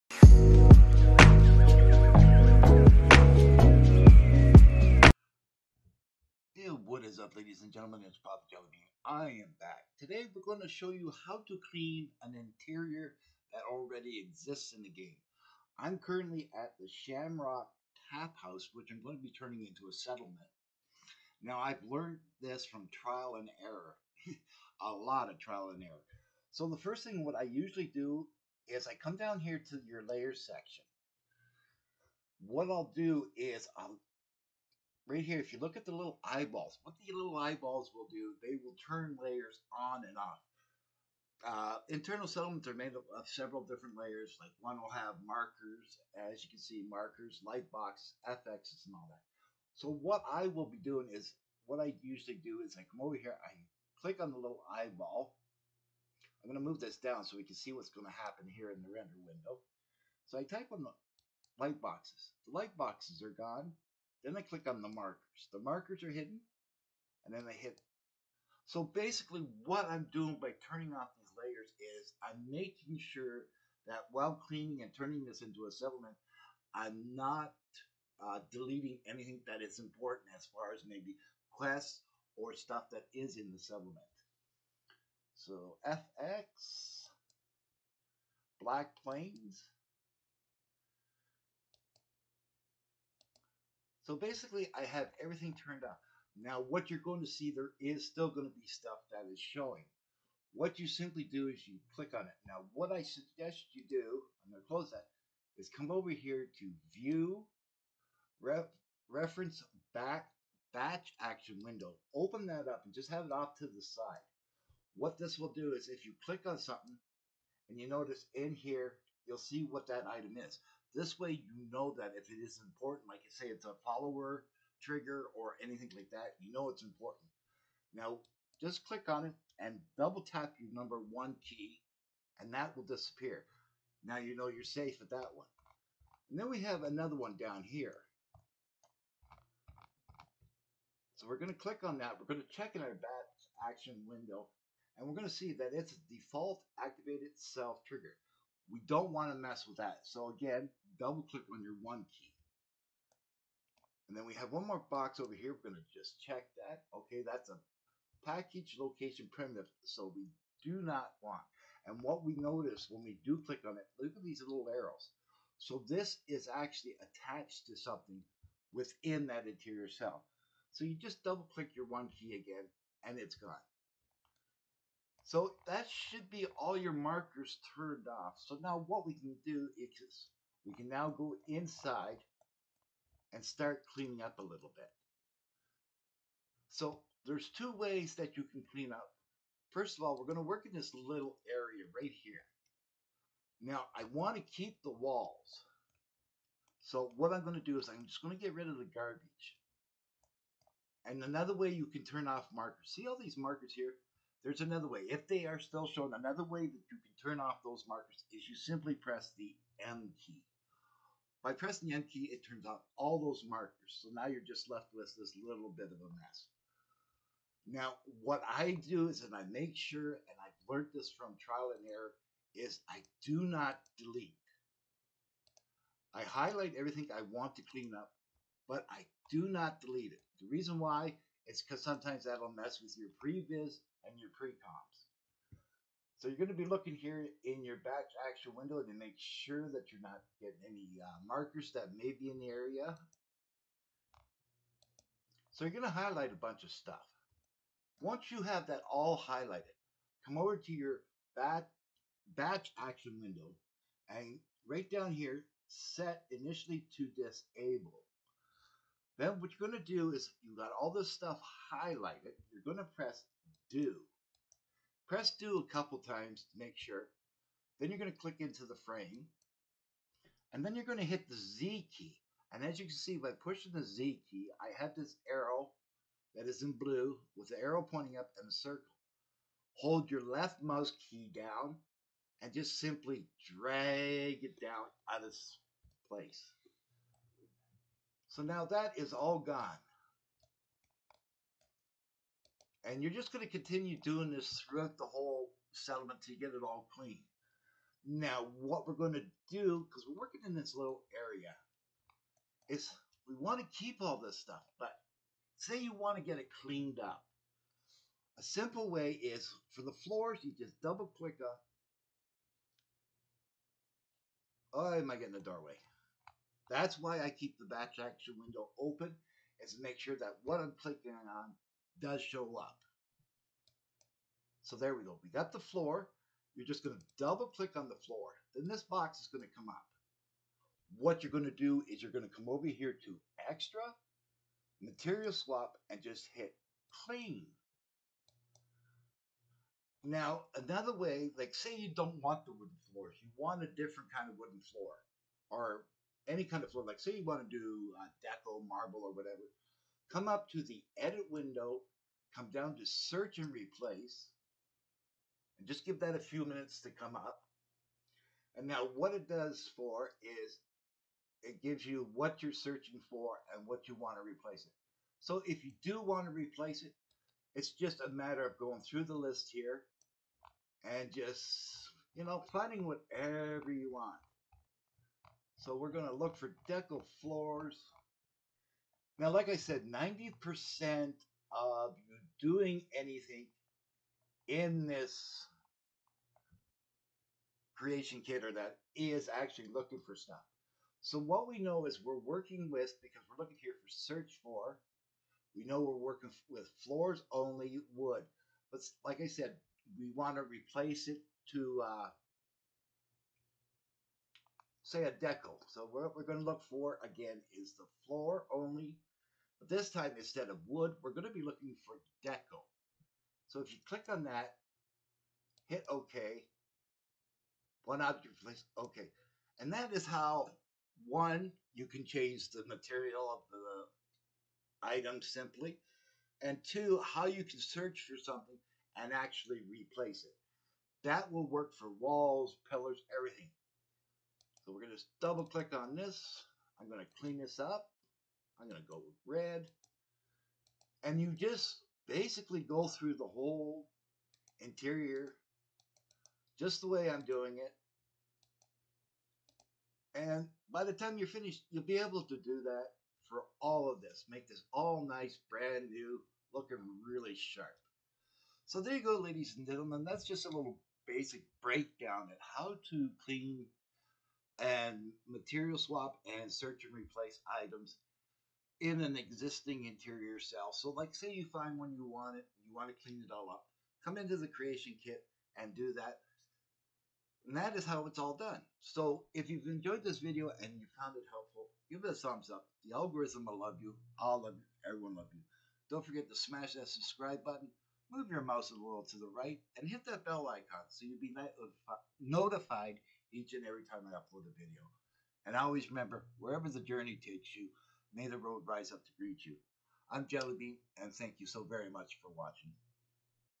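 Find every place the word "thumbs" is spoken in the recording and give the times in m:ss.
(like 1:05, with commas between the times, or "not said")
8:02.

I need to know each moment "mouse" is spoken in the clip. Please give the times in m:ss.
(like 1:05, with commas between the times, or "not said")
4:40, 8:08.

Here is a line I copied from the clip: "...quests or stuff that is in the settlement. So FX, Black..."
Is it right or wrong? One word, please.
right.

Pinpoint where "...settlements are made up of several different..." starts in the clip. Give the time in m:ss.
0:42.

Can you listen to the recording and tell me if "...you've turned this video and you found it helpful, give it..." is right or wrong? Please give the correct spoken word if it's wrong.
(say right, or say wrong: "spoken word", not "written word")
wrong: "enjoyed", not "turned".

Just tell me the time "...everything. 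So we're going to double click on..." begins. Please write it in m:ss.
7:13.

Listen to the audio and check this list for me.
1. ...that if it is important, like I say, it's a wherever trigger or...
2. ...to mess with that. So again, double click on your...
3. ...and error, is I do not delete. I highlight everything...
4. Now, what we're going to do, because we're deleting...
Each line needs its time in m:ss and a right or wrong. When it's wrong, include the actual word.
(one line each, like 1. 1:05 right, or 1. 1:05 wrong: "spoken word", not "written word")
1. 2:01 wrong: "follower", not "wherever"
2. 2:29 right
3. 3:41 right
4. 4:58 wrong: "working", not "deleting".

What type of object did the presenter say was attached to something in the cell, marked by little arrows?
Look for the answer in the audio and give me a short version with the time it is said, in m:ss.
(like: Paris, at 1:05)
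package location primitive, at 2:38.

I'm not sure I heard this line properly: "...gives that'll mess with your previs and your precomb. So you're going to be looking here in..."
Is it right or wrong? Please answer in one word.
wrong.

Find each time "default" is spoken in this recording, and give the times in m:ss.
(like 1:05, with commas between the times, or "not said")
2:26.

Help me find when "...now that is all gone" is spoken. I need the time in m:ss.
4:48.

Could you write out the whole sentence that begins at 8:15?
And always remember, wherever the journey takes you, May the road rise up to greet you.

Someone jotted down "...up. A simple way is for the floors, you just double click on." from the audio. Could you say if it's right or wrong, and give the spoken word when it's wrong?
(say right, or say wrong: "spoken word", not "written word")
right.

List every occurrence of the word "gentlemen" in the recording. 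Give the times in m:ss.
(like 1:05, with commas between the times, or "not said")
0:07, 7:39.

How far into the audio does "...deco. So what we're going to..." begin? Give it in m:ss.
6:45.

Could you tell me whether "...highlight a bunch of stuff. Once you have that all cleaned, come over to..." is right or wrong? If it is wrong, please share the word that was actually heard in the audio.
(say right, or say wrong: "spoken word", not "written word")
wrong: "highlighted", not "cleaned".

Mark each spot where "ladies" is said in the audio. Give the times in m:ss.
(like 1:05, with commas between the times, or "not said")
0:07, 7:39.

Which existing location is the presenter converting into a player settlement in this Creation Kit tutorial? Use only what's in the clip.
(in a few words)
Shamrock Tap House.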